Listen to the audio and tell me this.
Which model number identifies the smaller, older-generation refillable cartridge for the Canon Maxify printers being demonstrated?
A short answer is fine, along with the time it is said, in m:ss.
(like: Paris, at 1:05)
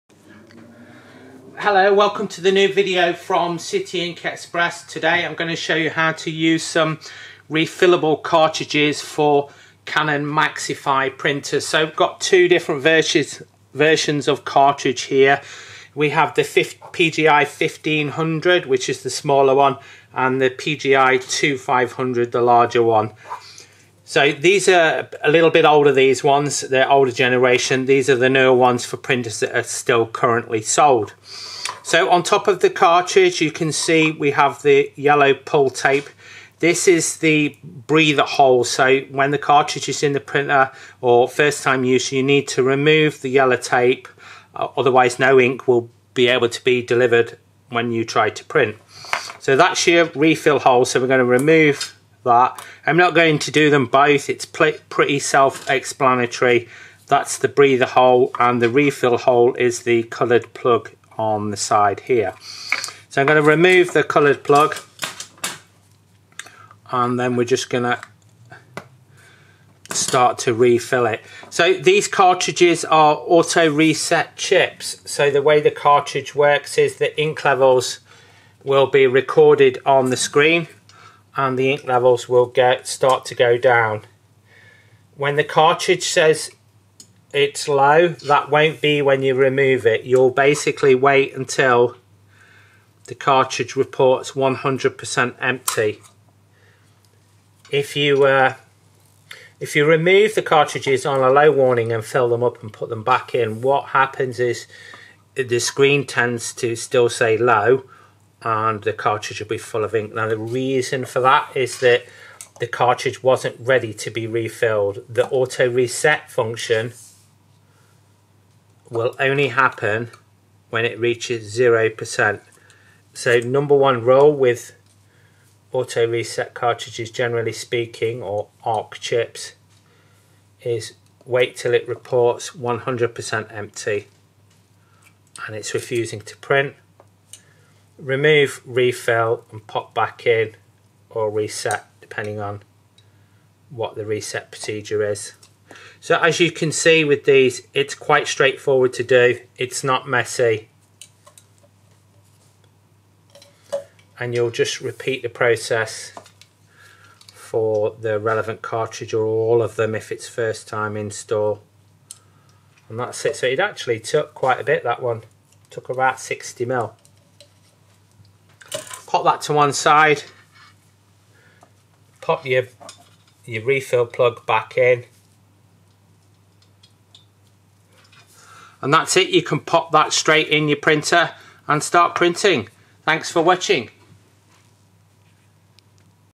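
PGI 1500, at 0:16.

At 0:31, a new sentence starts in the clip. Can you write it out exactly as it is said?
So on top of the cartridge, you can see we have the yellow pull tape.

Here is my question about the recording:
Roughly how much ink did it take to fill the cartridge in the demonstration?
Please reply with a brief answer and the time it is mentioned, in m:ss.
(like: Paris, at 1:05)
60 ml, at 2:46.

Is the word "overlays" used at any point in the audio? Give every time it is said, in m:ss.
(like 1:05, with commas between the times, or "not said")
not said.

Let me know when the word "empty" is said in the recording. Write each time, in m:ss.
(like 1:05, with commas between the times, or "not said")
1:35, 2:13.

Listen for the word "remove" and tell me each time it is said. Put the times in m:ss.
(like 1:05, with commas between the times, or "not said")
0:42, 0:51, 1:03, 1:29, 1:39, 2:18.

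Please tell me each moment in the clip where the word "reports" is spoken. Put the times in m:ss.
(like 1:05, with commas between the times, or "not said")
1:33, 2:11.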